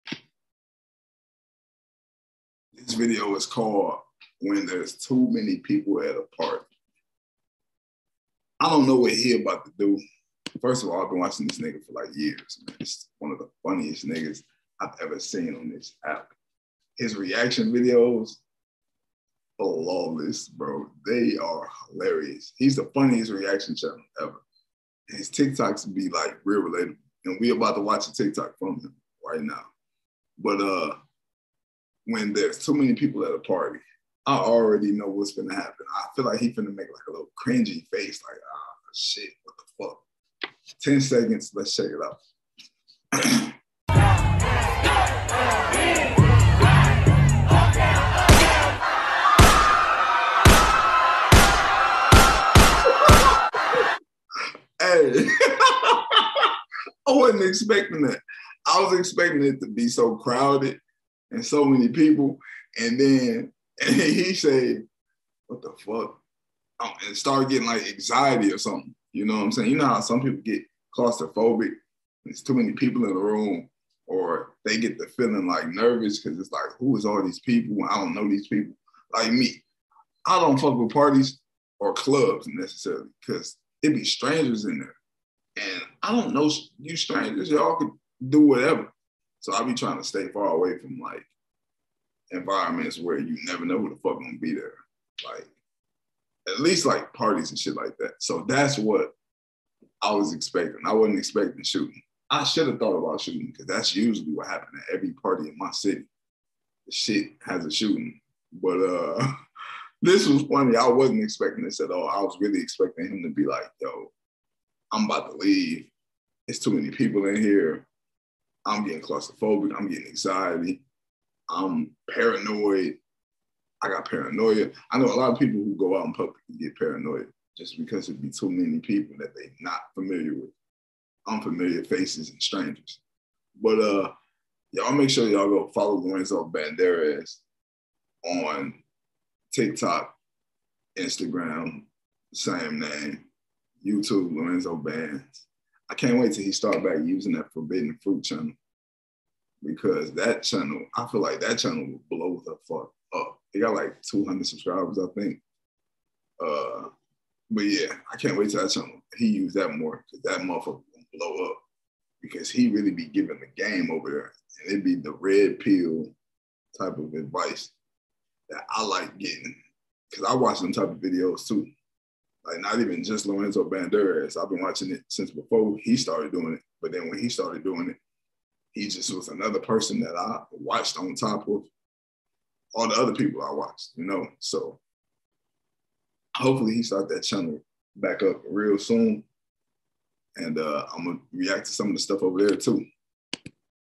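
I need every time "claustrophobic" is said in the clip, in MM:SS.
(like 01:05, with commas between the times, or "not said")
01:10, 01:59.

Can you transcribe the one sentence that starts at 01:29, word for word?
So I be trying to stay far away from like environments where you never know who the fuck gonna be there.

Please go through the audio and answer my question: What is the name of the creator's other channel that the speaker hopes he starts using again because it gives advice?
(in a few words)
Forbidden Fruit.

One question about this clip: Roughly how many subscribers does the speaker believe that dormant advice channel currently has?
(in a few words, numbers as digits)
200.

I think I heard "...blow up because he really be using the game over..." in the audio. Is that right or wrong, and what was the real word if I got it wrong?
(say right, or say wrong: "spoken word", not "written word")
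wrong: "giving", not "using".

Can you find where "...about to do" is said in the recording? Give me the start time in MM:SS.
00:09.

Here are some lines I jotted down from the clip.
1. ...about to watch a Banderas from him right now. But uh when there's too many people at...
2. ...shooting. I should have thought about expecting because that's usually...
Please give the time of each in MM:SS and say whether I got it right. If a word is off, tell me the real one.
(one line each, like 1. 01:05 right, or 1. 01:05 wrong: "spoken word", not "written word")
1. 00:27 wrong: "TikTok", not "Banderas"
2. 01:41 wrong: "shooting", not "expecting".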